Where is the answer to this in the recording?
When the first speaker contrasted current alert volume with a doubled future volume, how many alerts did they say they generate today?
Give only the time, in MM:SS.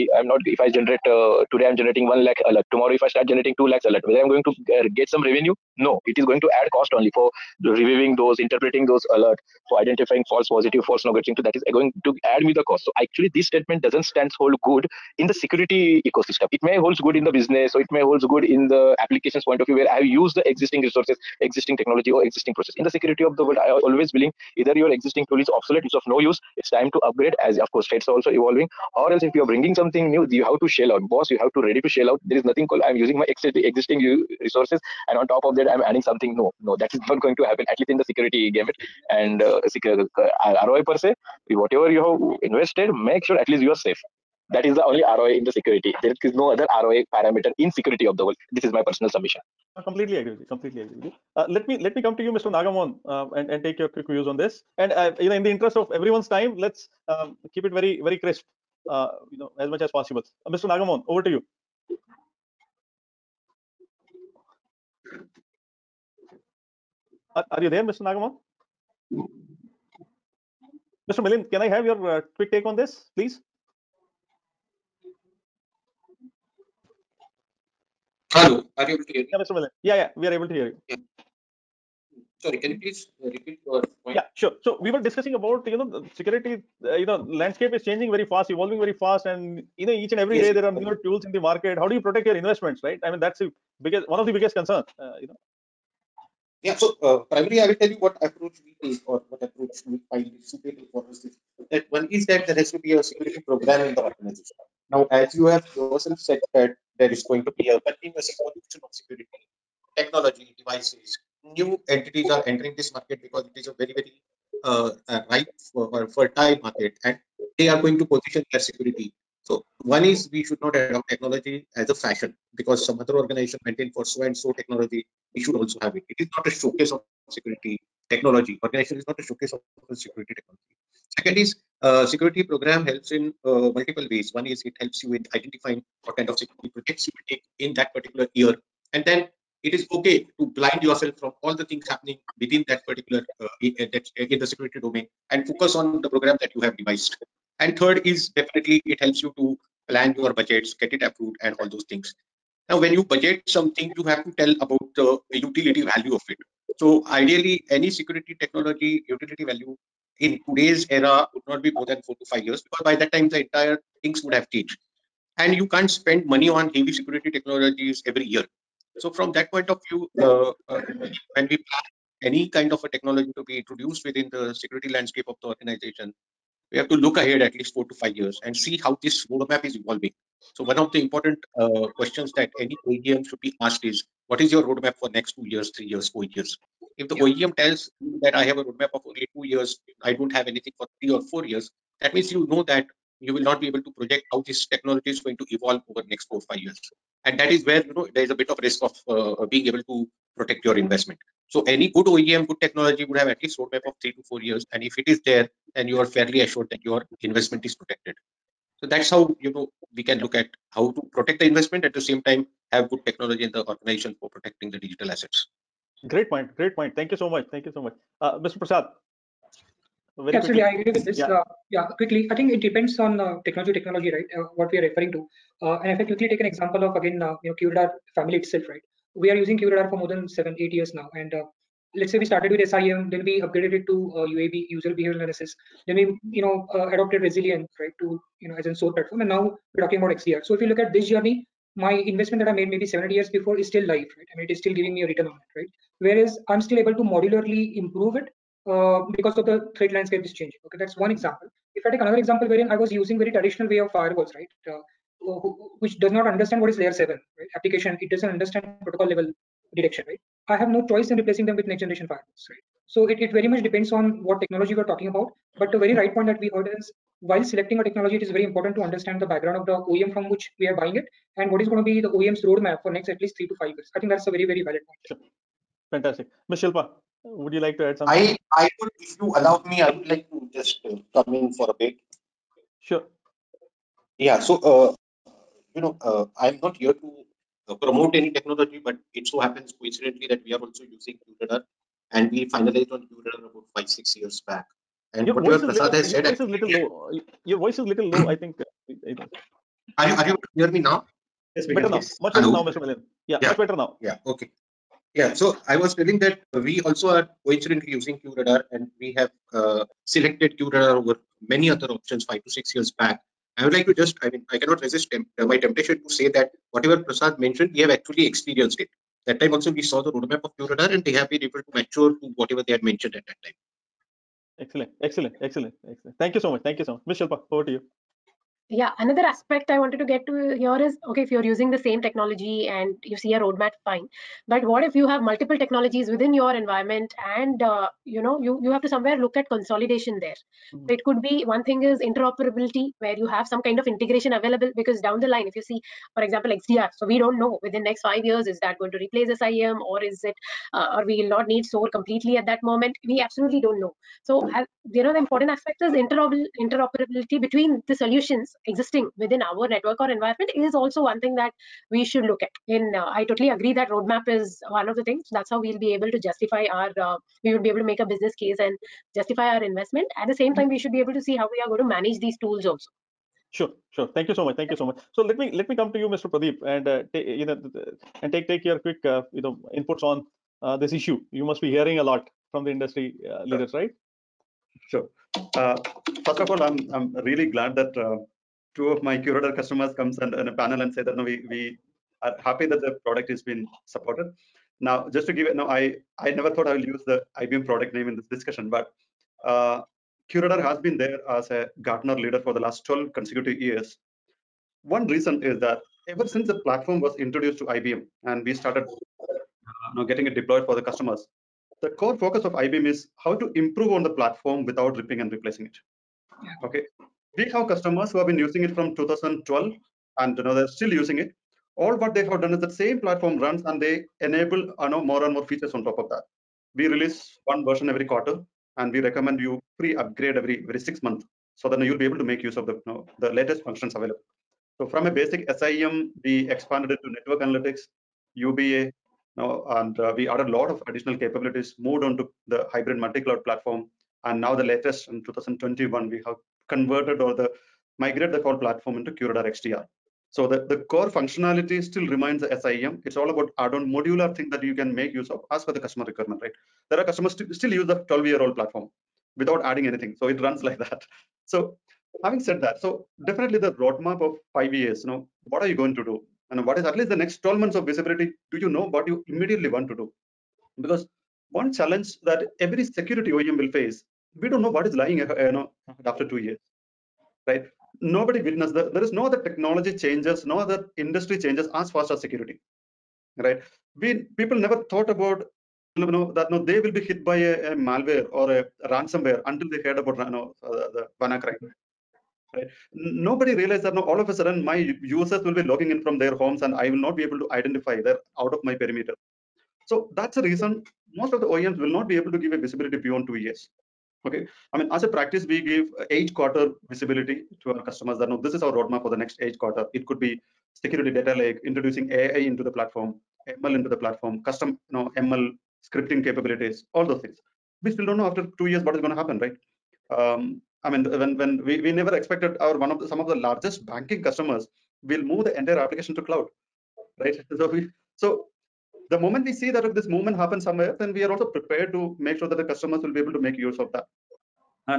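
00:02.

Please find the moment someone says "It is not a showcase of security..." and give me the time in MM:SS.
02:06.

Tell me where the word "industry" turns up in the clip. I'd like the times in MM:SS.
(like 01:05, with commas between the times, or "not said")
06:22, 08:00.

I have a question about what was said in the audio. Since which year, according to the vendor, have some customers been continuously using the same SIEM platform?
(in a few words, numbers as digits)
2012.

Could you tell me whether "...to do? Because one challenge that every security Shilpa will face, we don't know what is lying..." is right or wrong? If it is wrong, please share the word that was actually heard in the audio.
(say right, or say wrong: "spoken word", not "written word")
wrong: "OEM", not "Shilpa".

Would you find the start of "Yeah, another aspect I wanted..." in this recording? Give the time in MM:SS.
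05:28.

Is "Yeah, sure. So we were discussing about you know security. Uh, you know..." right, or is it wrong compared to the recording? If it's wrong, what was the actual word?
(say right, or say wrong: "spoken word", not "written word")
right.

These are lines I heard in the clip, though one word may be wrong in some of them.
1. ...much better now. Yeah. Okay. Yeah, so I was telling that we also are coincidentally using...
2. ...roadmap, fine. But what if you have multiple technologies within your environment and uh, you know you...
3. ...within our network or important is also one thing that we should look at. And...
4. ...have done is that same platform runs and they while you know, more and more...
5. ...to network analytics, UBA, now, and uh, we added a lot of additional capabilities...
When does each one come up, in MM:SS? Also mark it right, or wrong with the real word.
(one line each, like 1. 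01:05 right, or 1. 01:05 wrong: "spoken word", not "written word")
1. 05:03 right
2. 05:33 right
3. 05:59 wrong: "environment", not "important"
4. 07:02 wrong: "enable", not "while"
5. 07:17 right.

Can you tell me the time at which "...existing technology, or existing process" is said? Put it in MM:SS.
00:21.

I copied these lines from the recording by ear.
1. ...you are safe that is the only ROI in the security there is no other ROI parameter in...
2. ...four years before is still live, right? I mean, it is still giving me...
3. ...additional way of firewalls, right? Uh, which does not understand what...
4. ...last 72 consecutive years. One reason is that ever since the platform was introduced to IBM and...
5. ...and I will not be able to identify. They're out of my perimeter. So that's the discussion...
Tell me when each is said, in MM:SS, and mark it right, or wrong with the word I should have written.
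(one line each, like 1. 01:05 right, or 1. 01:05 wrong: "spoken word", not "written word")
1. 00:43 right
2. 04:03 wrong: "eight", not "four"
3. 04:13 wrong: "traditional", not "additional"
4. 06:42 wrong: "12", not "72"
5. 08:16 wrong: "reason", not "discussion".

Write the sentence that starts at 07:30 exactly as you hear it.
So the, the core functionality still remains the SIEM.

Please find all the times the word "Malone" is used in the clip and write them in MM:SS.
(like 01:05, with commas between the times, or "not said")
not said.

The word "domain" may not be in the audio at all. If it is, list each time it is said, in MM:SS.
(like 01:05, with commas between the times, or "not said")
02:24.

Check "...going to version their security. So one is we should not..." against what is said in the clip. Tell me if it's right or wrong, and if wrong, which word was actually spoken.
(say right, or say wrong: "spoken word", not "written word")
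wrong: "position", not "version".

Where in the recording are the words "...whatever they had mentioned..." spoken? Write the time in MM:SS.
05:22.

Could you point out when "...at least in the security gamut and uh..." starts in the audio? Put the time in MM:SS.
00:37.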